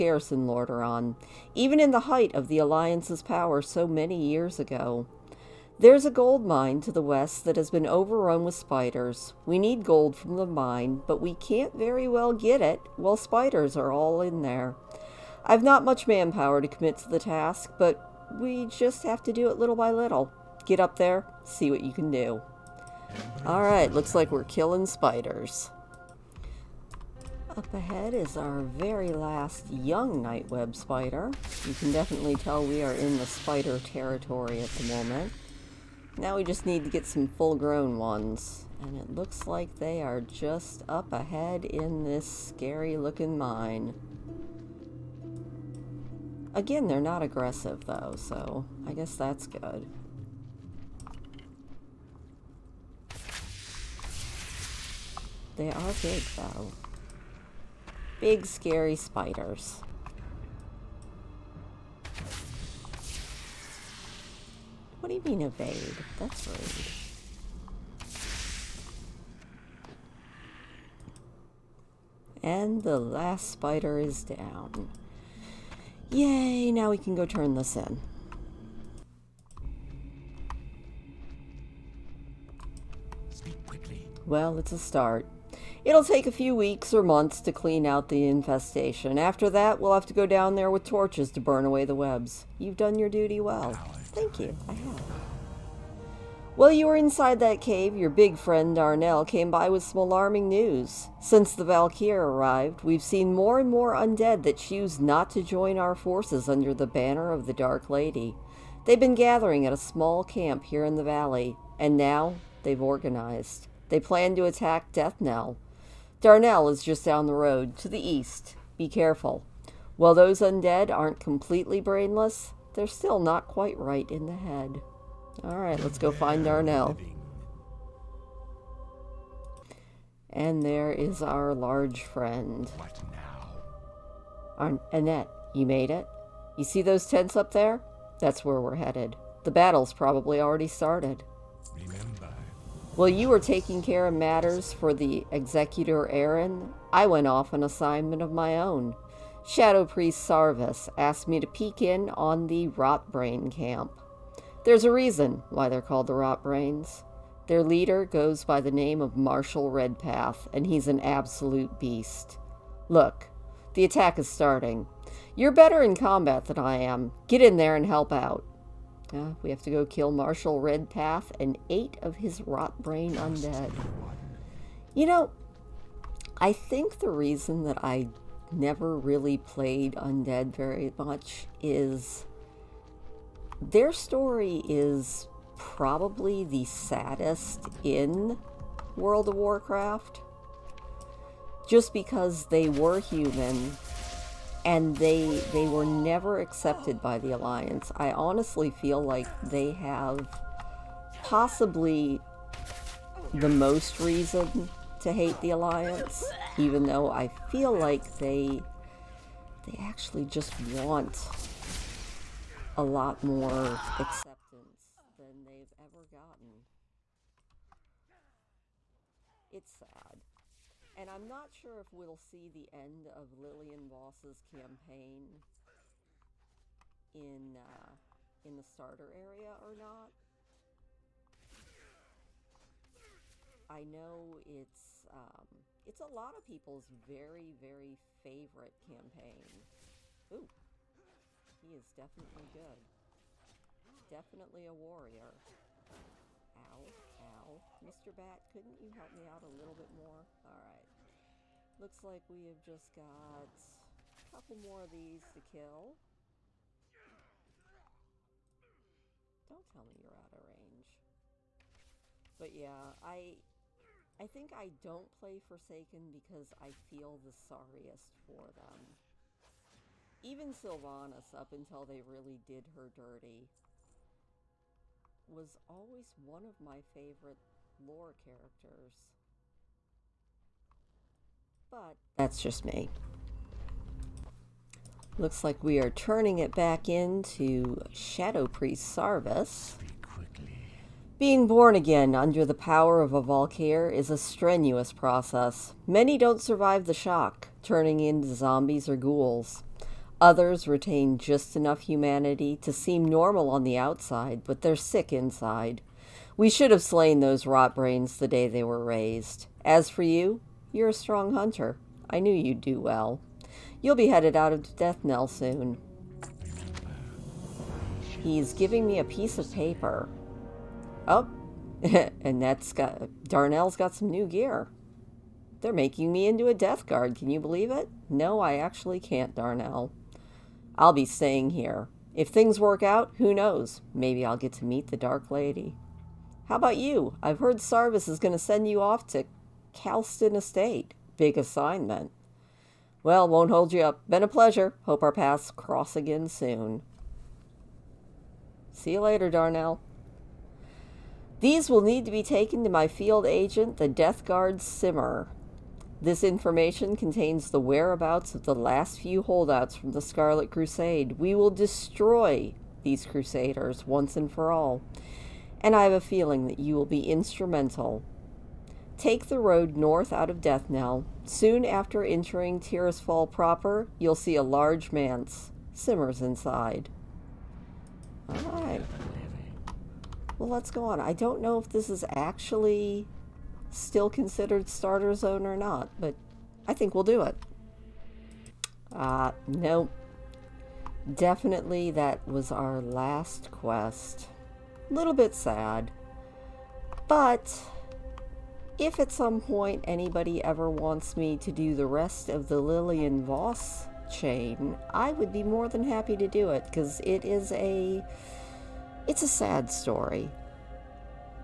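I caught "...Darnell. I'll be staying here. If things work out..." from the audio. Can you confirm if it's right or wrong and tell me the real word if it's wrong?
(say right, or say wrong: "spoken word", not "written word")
right.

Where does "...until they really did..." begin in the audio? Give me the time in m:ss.
4:31.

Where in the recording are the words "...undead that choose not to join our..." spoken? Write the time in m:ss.
1:43.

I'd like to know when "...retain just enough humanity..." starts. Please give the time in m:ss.
5:00.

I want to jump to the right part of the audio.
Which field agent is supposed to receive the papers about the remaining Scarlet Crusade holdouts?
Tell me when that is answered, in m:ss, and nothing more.
5:53.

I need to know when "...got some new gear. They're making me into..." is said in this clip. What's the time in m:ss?
5:23.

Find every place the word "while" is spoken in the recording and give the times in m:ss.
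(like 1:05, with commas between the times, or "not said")
0:12, 1:36, 1:59, 2:22.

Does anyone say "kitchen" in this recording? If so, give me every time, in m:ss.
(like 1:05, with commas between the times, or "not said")
not said.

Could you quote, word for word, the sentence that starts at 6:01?
We will destroy these crusaders once and for all, and I have a feeling that you will be instrumental.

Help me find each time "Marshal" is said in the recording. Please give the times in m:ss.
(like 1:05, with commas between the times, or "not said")
2:39, 2:50.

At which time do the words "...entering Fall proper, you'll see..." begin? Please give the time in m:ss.
6:12.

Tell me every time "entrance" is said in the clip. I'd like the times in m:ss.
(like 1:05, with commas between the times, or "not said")
not said.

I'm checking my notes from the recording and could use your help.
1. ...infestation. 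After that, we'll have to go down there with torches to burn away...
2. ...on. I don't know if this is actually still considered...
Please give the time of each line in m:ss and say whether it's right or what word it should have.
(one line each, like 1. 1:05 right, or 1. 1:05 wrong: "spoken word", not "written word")
1. 1:28 right
2. 6:20 right.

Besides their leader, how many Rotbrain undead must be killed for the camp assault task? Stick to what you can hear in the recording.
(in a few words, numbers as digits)
8.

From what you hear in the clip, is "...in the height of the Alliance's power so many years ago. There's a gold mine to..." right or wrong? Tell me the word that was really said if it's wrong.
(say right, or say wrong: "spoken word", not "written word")
right.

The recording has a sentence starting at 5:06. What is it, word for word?
We should have slain those rot brains the day they were raised.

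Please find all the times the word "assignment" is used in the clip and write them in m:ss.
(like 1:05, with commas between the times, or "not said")
2:27, 5:41.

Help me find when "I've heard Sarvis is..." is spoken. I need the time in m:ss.
5:37.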